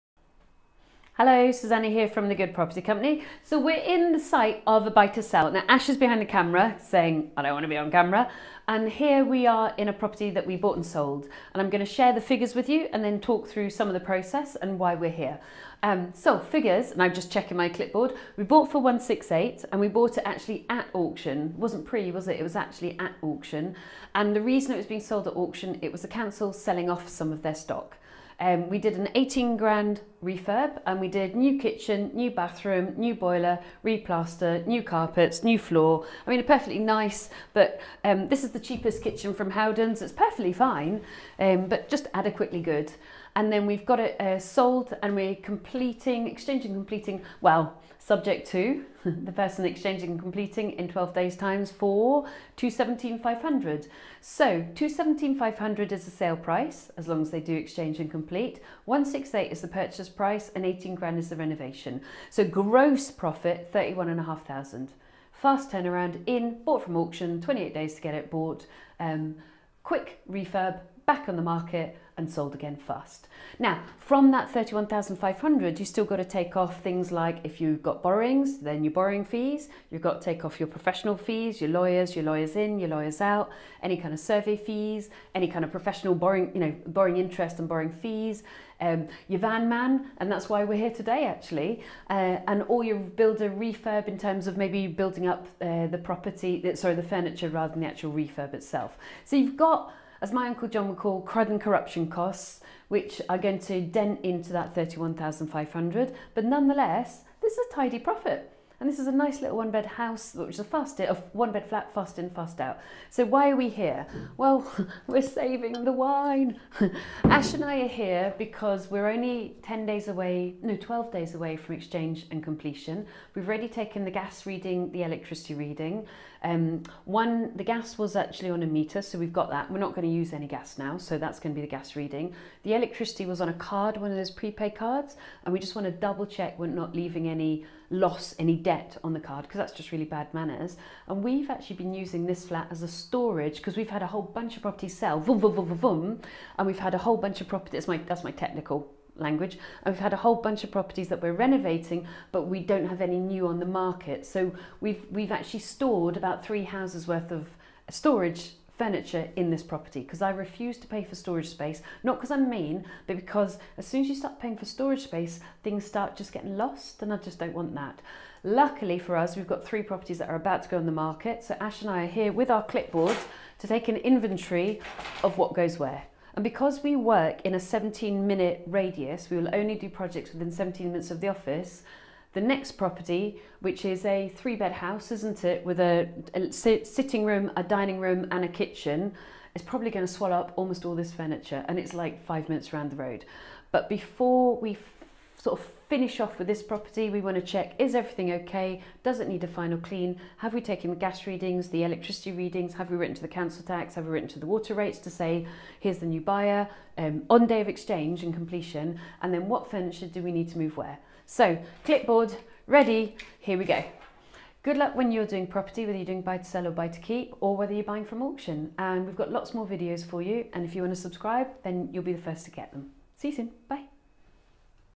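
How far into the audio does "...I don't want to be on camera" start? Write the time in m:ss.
0:07.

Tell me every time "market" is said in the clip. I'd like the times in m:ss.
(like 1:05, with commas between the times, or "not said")
1:11, 2:33, 2:50.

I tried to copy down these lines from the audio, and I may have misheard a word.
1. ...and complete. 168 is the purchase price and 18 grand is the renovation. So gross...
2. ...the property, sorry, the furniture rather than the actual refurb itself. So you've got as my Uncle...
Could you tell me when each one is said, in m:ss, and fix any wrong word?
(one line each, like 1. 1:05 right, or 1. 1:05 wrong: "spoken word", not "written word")
1. 0:57 right
2. 1:35 right.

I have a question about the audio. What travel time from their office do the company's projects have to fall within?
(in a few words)
17 minutes.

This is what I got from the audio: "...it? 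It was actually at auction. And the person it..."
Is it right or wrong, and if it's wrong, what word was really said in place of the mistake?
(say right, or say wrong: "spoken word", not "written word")
wrong: "reason", not "person".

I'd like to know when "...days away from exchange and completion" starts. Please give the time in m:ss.
2:01.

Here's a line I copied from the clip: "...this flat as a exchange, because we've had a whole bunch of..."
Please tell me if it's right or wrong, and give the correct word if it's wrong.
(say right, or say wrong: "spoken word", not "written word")
wrong: "storage", not "exchange".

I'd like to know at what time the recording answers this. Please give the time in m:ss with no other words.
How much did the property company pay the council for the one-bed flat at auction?
0:18.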